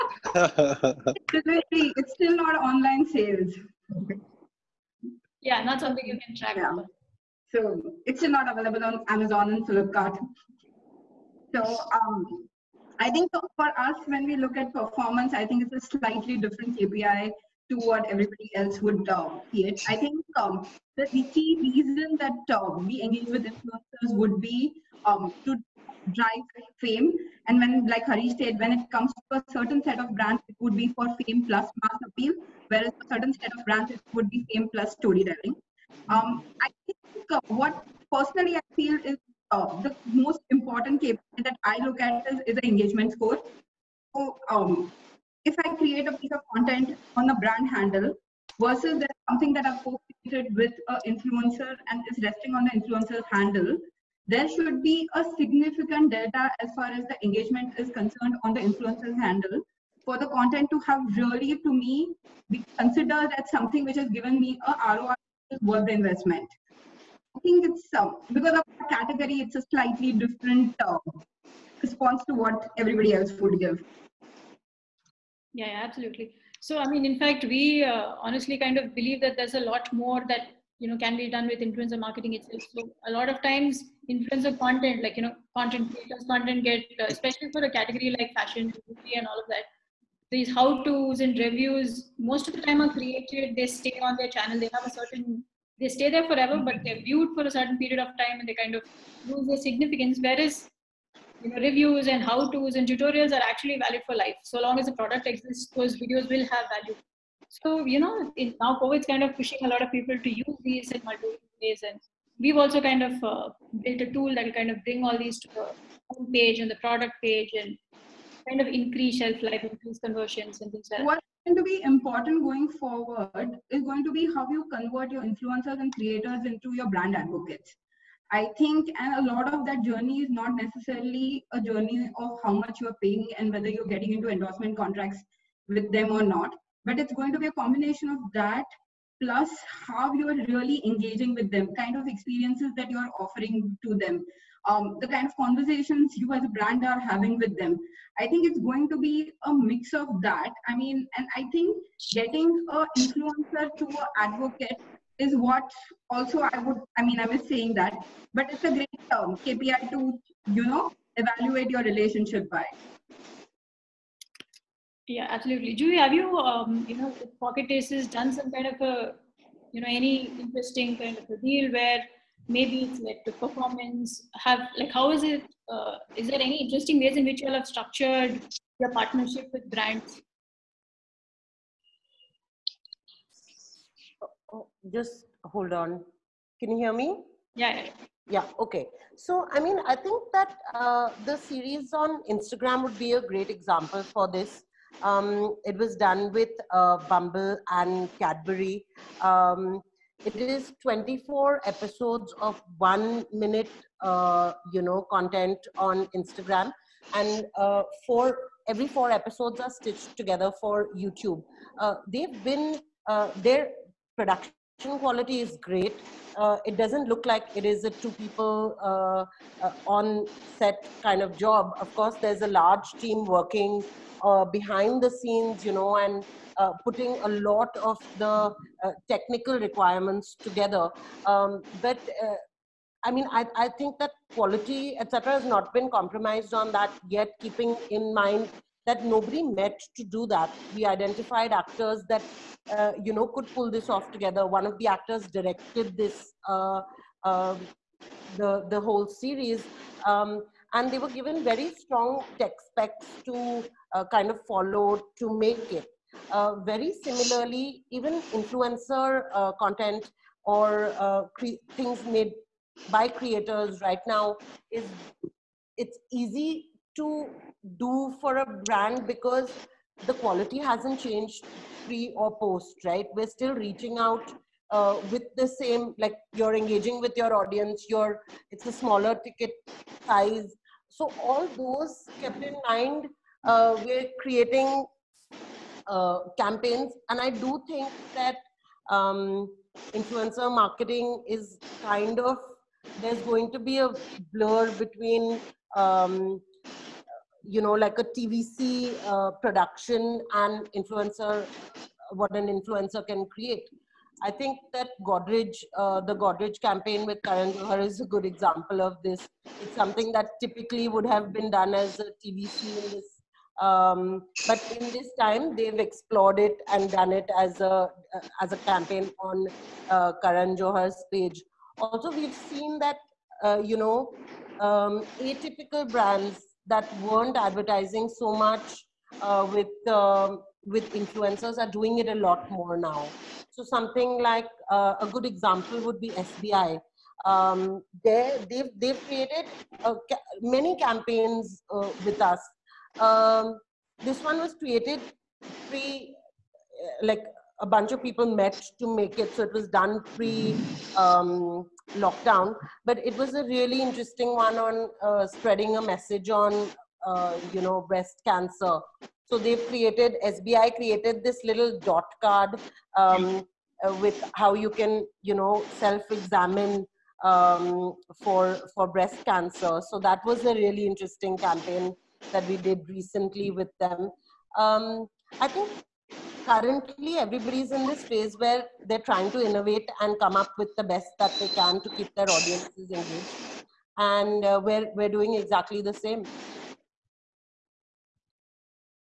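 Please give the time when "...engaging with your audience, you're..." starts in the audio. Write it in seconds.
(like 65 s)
276 s.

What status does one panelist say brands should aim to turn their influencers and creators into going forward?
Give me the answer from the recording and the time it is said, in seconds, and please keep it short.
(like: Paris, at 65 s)
Brand advocates, at 126 s.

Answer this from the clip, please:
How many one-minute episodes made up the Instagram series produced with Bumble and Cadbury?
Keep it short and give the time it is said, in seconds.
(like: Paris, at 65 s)
24, at 200 s.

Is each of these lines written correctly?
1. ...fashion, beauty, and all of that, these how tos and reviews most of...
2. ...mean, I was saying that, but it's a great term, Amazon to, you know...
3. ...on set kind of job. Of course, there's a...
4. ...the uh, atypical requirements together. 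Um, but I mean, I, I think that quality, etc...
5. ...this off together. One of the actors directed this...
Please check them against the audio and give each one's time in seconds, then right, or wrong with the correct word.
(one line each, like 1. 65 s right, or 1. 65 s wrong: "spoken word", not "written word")
1. 88 s right
2. 157 s wrong: "KPI", not "Amazon"
3. 219 s right
4. 228 s wrong: "technical", not "atypical"
5. 243 s right.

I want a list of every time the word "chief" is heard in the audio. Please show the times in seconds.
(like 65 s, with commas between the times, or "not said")
not said.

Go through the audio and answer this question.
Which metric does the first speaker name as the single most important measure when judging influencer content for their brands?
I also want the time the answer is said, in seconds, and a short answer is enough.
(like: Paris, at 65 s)
Engagement score, at 42 s.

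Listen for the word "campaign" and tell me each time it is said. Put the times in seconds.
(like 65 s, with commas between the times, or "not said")
286 s, 306 s, 318 s, 340 s, 371 s.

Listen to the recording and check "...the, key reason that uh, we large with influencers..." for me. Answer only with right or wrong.
wrong.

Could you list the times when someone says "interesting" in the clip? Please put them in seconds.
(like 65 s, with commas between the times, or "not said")
170 s, 176 s, 353 s, 370 s.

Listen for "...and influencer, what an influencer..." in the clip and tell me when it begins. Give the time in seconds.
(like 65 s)
300 s.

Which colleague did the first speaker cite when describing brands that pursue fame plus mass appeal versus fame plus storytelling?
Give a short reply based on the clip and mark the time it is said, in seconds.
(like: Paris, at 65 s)
Harish, at 28 s.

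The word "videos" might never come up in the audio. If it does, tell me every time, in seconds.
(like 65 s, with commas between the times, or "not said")
105 s.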